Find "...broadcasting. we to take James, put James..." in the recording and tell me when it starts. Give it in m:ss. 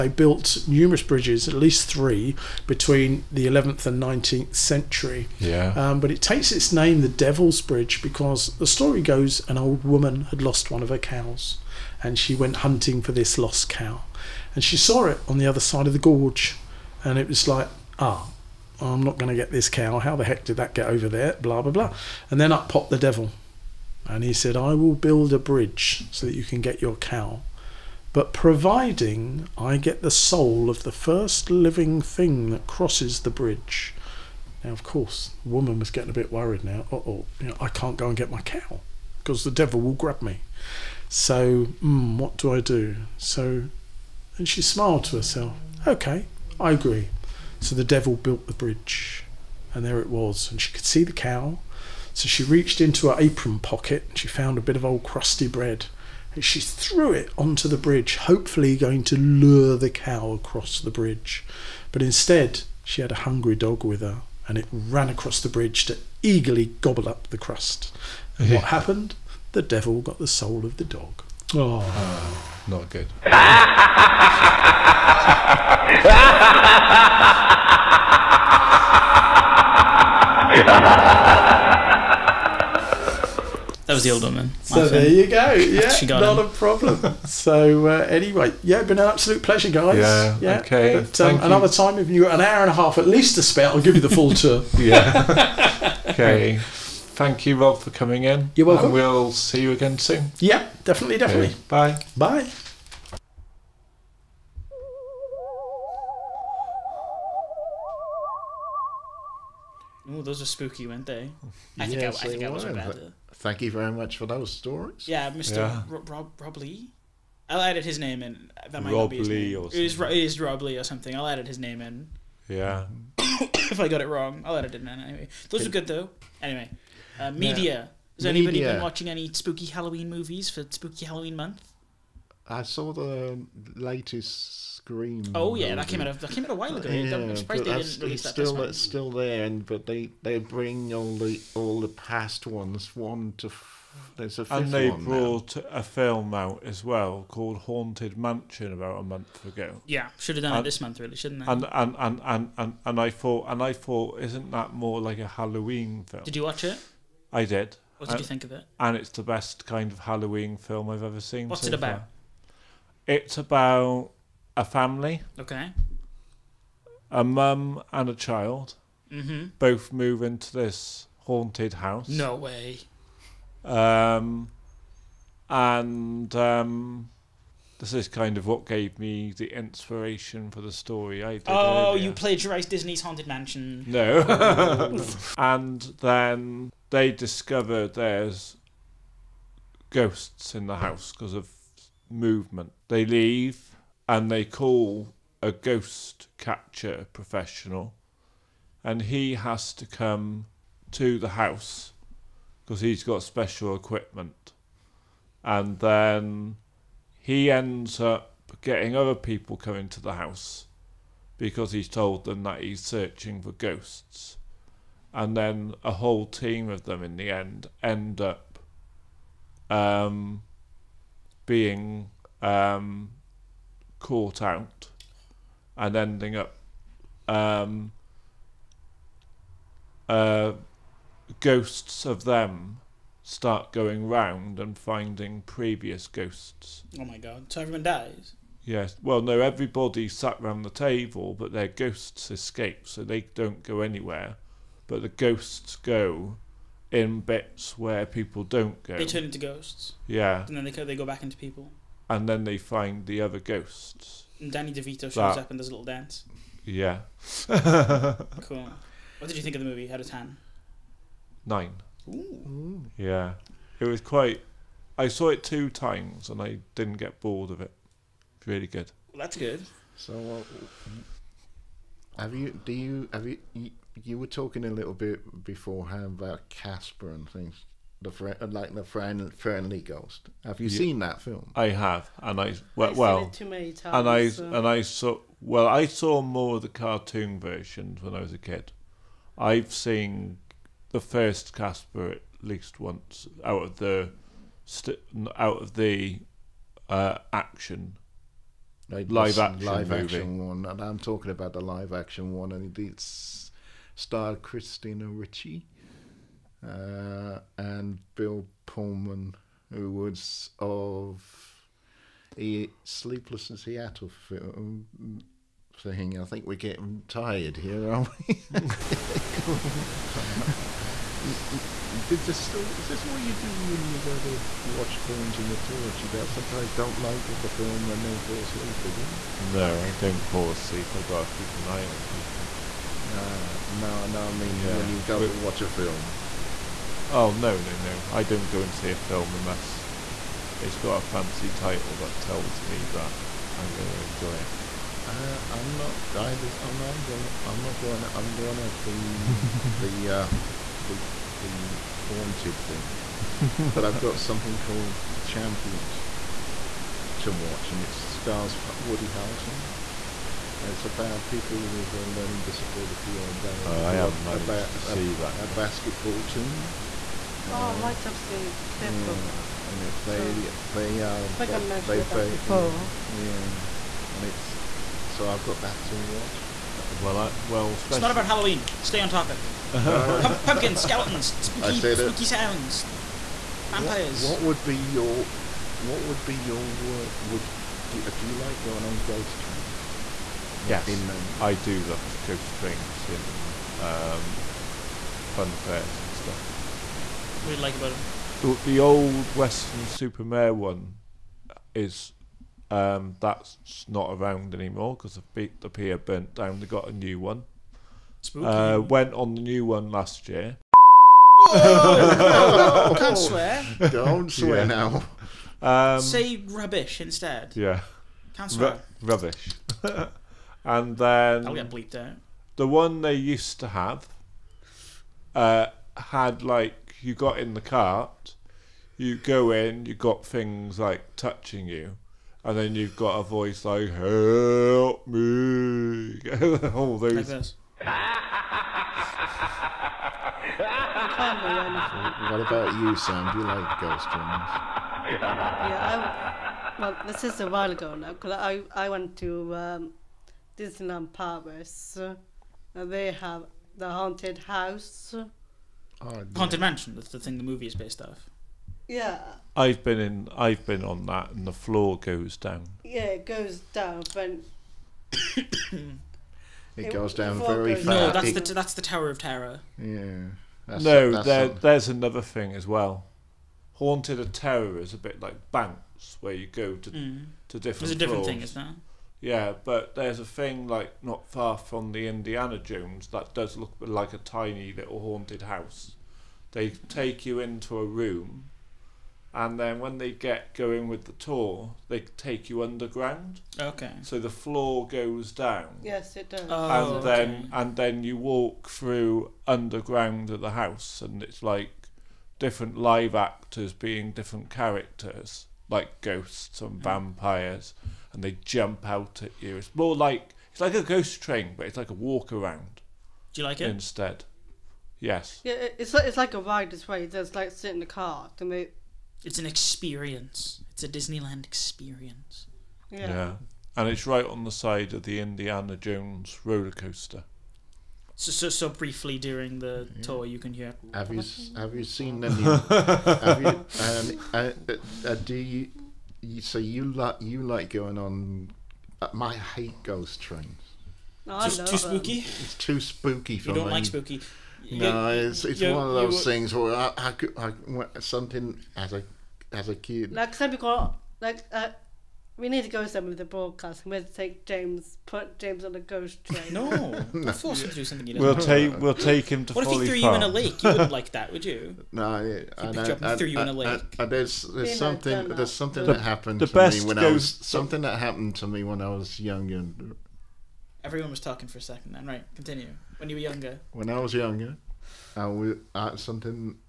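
9:13.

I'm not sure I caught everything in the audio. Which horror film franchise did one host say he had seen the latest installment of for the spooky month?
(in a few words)
Scream.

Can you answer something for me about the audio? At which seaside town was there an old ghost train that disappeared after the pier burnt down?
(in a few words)
Weston-super-Mare.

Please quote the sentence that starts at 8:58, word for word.
Uh, my I hate ghost trains.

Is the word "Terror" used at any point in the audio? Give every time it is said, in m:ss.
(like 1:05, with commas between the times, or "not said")
7:49, 7:54.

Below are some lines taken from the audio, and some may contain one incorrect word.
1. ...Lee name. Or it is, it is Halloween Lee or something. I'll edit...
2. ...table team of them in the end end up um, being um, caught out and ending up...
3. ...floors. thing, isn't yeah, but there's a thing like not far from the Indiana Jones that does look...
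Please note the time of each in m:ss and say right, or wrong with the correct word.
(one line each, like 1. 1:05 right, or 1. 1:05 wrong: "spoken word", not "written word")
1. 1:59 wrong: "Rob", not "Halloween"
2. 3:35 wrong: "whole", not "table"
3. 7:58 right.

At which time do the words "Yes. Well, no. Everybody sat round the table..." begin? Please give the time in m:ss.
3:58.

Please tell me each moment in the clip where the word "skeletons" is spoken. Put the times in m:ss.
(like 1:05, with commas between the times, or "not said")
6:20.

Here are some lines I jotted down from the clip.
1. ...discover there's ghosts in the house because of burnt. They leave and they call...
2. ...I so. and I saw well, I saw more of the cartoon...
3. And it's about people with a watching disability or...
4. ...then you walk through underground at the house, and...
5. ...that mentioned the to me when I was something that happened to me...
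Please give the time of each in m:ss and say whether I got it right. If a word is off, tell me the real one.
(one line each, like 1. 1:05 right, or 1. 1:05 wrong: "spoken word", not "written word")
1. 3:07 wrong: "movement", not "burnt"
2. 4:44 right
3. 6:00 wrong: "learning", not "watching"
4. 8:17 right
5. 9:25 wrong: "happened", not "mentioned".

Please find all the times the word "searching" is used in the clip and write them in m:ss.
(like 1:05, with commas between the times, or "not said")
3:32.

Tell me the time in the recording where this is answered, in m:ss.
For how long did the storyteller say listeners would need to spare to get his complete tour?
1:32.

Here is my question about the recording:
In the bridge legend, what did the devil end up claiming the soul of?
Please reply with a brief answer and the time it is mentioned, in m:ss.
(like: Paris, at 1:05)
the dog, at 1:09.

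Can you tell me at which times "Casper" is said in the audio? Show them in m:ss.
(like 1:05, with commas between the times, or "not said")
4:36, 4:51.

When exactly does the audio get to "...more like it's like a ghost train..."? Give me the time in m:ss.
8:29.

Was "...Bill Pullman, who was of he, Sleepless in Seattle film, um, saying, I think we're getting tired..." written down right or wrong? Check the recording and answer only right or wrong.
right.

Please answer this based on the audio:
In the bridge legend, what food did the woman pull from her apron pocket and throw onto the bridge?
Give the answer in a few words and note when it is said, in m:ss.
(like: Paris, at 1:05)
crusty bread, at 0:54.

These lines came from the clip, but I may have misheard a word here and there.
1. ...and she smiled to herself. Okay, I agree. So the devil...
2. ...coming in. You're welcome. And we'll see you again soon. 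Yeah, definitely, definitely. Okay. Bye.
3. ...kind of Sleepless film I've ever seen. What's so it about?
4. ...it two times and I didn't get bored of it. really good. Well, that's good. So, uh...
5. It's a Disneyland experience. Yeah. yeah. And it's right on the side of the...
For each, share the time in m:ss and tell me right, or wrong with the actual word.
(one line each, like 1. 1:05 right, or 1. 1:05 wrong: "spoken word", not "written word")
1. 0:44 right
2. 1:37 right
3. 2:39 wrong: "Halloween", not "Sleepless"
4. 4:25 right
5. 8:40 right.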